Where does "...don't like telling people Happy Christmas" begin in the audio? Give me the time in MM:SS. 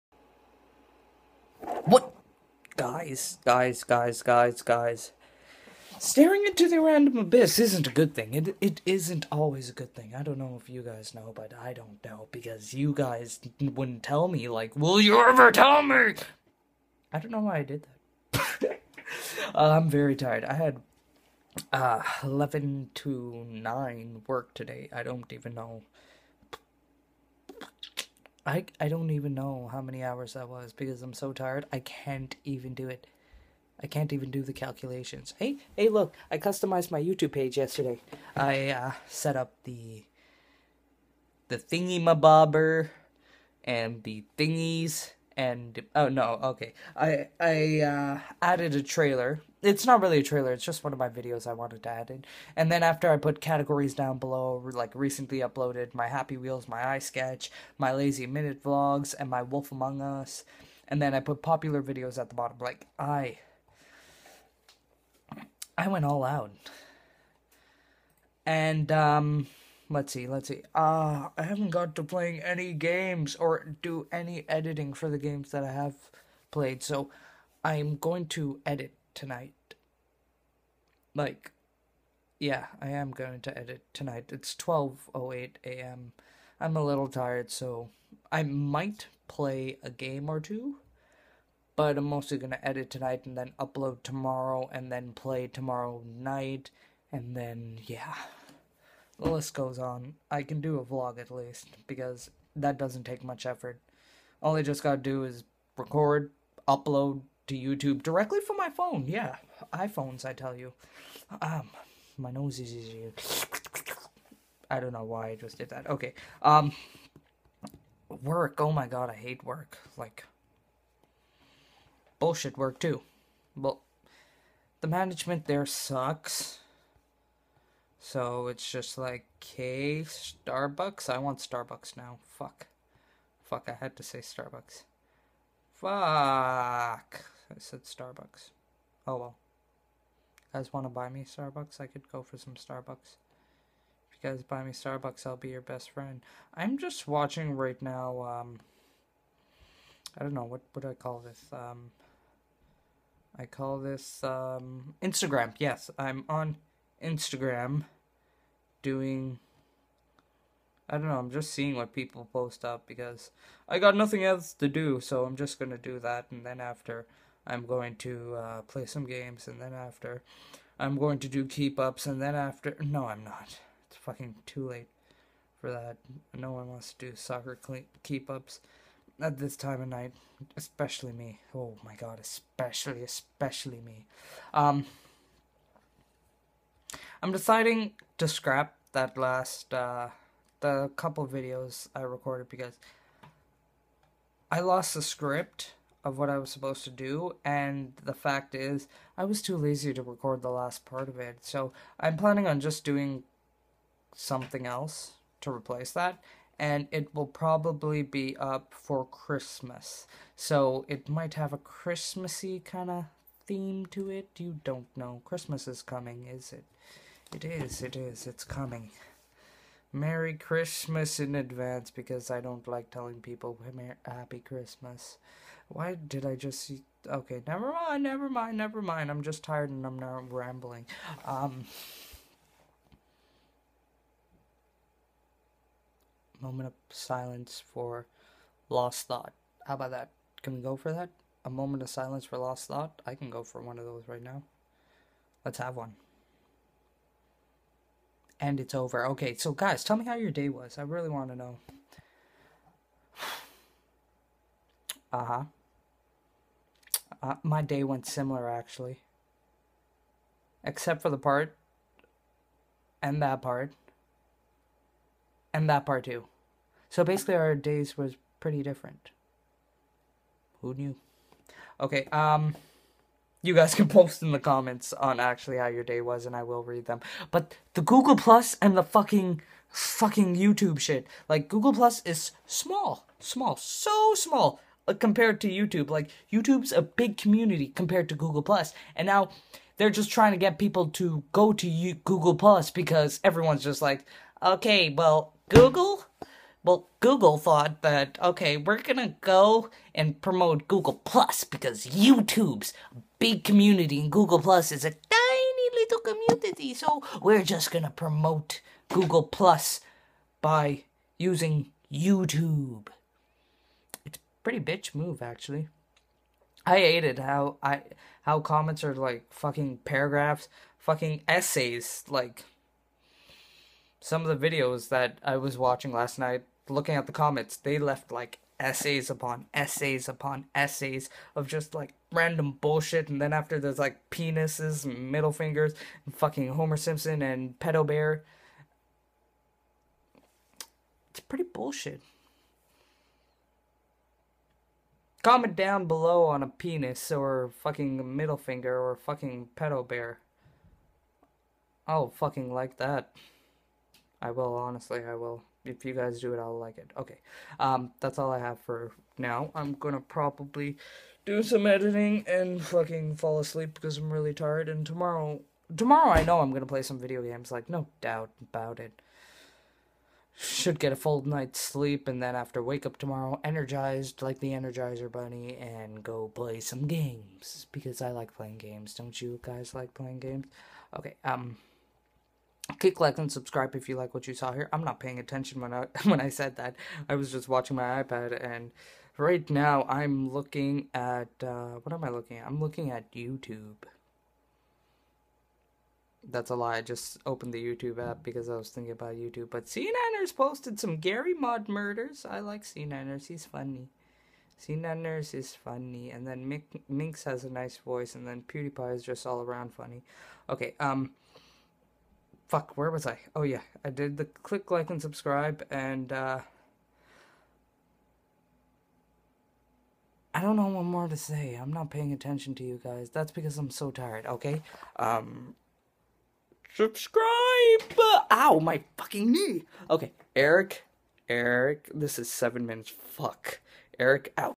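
03:42.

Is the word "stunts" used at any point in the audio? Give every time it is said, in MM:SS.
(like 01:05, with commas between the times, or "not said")
not said.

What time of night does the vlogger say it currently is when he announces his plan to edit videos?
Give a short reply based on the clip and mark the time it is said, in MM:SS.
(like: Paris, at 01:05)
12:08 a.m., at 01:24.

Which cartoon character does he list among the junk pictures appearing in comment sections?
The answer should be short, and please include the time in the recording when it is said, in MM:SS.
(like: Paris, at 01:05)
Homer Simpson, at 05:36.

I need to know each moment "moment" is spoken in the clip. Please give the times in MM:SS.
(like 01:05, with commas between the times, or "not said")
03:56, 04:01.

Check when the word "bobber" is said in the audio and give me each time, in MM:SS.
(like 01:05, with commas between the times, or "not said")
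00:42.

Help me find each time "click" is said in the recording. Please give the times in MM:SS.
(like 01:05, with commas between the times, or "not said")
06:22, 06:54.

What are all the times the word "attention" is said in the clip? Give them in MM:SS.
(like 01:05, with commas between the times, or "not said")
06:25, 07:02.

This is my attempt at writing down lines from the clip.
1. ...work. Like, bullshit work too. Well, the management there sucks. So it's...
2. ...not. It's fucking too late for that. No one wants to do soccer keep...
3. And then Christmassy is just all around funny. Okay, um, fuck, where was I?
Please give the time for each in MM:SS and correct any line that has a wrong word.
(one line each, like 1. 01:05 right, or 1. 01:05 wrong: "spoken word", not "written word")
1. 01:59 right
2. 02:53 right
3. 06:48 wrong: "PewDiePie", not "Christmassy".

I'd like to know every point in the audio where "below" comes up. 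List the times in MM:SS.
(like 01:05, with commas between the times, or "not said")
00:54, 05:45.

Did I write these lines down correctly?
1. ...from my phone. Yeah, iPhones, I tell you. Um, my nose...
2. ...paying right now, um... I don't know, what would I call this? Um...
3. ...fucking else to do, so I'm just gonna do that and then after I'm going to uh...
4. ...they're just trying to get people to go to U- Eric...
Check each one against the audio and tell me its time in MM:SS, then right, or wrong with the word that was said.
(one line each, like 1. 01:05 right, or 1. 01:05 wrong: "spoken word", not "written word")
1. 01:48 right
2. 02:27 wrong: "watching", not "paying"
3. 02:43 wrong: "nothing", not "fucking"
4. 04:49 wrong: "Google", not "Eric".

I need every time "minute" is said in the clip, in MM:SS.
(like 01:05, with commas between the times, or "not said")
00:58, 07:12.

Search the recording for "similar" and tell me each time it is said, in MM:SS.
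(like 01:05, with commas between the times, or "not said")
04:18.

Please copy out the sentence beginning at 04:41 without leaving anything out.
Like Google Plus is small, small, so small uh, compared to YouTube.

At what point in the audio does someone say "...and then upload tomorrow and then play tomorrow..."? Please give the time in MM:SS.
01:33.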